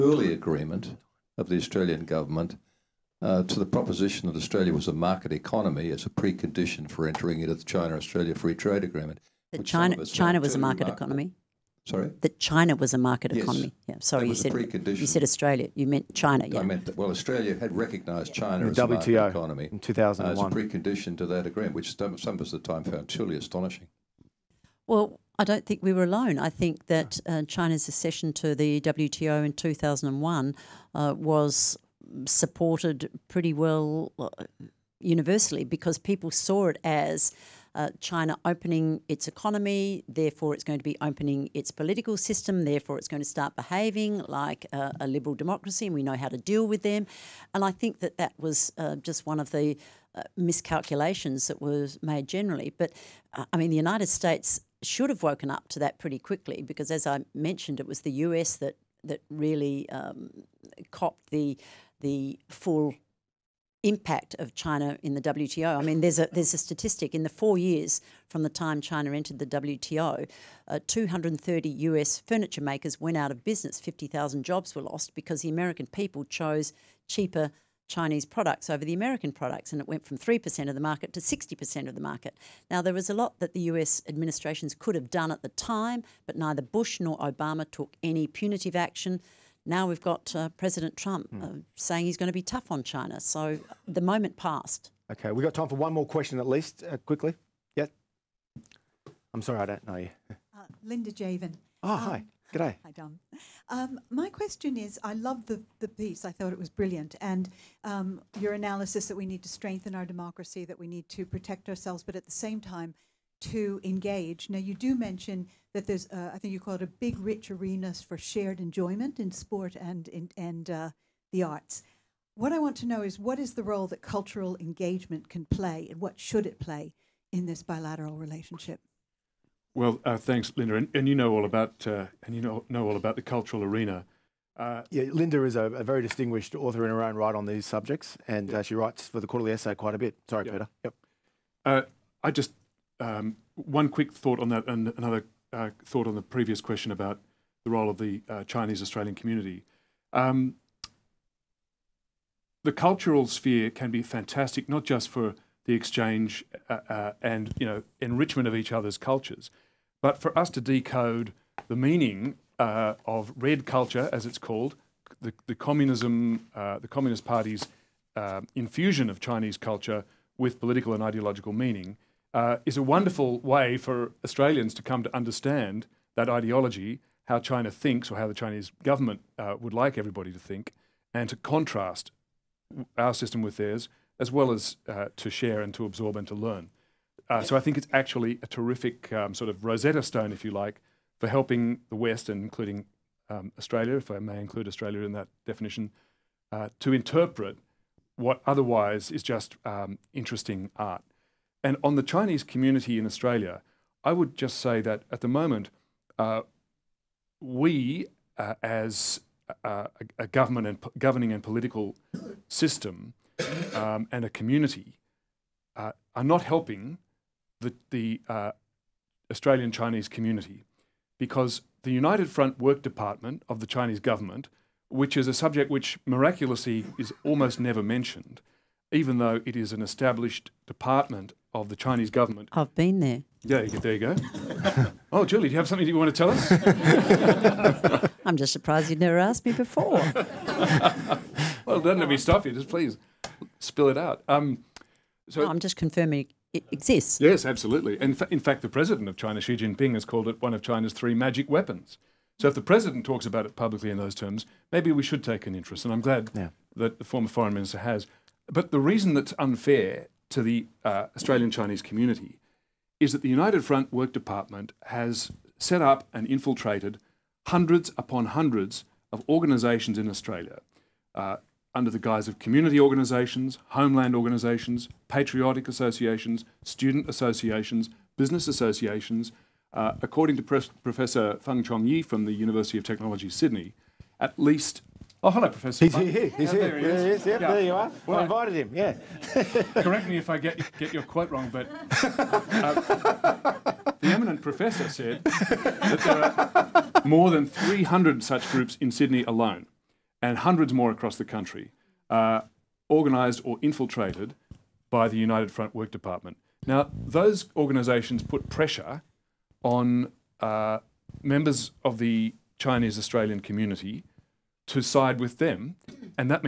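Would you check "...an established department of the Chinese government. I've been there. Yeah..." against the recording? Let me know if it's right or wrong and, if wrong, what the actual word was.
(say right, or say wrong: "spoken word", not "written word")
right.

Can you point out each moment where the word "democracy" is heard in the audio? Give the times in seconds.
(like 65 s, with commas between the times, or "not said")
45 s, 110 s.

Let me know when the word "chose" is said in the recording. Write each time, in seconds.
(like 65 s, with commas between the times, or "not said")
76 s.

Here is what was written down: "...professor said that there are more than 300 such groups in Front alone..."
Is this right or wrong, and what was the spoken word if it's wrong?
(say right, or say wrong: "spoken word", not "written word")
wrong: "Sydney", not "Front".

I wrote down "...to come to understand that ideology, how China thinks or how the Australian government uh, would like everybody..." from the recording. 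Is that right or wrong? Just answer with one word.
wrong.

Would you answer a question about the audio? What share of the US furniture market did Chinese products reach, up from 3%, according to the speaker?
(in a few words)
60%.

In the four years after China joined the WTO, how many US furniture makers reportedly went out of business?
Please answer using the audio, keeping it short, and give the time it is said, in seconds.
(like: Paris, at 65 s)
230, at 70 s.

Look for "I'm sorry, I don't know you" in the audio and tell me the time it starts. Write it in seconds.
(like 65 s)
99 s.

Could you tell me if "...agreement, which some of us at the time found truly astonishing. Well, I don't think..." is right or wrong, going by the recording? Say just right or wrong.
right.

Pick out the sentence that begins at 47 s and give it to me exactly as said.
And I think that that was uh, just one of the uh, miscalculations that was made generally.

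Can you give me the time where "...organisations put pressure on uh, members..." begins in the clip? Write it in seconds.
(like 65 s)
307 s.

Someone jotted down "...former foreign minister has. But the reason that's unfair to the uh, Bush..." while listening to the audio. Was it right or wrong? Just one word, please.
wrong.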